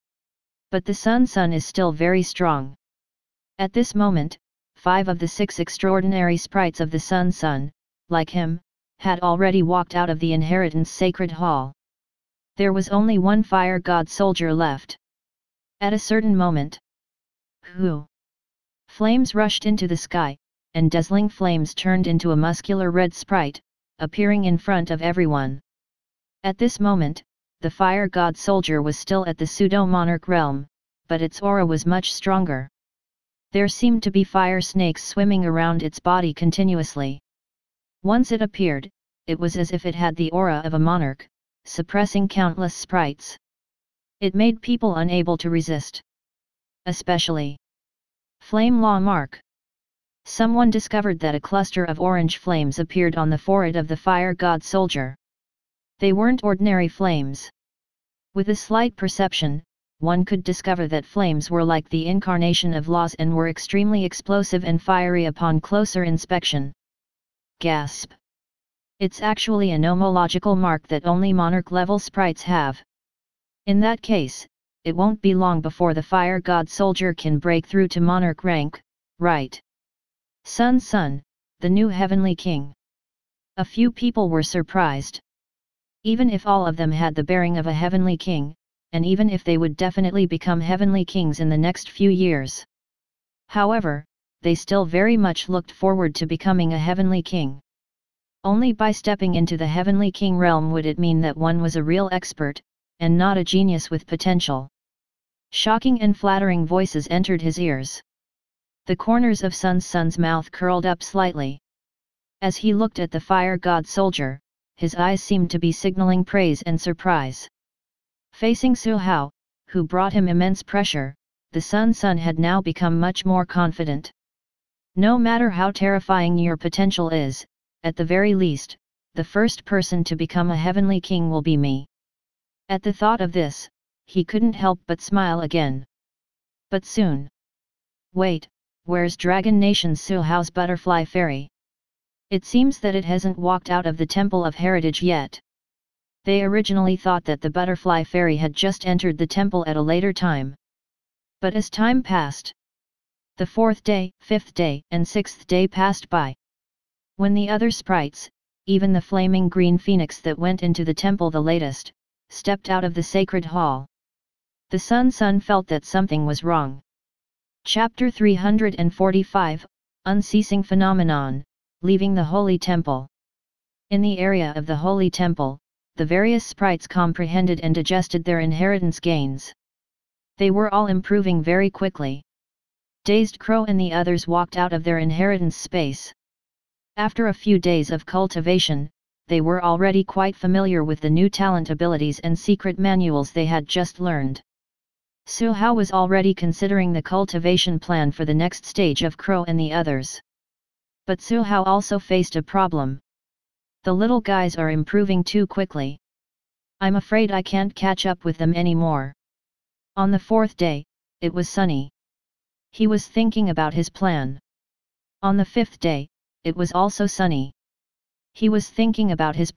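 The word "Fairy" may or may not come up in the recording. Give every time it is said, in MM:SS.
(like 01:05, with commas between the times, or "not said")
02:21, 02:28.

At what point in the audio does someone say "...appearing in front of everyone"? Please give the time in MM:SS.
00:23.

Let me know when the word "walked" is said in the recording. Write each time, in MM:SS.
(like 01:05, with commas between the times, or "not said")
00:09, 02:23, 03:04.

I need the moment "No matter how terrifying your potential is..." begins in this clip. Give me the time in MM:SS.
02:04.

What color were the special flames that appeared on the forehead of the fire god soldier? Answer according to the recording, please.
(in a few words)
Orange.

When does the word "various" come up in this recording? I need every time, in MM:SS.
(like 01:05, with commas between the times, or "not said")
02:56.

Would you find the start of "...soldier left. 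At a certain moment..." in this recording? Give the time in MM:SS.
00:14.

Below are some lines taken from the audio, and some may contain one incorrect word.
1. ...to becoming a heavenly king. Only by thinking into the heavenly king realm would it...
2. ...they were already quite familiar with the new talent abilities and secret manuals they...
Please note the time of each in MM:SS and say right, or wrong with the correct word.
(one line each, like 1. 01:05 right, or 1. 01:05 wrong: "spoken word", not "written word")
1. 01:36 wrong: "stepping", not "thinking"
2. 03:09 right.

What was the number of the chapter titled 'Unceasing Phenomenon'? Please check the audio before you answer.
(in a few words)
345.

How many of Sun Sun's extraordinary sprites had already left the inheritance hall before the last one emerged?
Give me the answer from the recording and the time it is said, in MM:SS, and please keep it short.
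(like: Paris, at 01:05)
5, at 00:04.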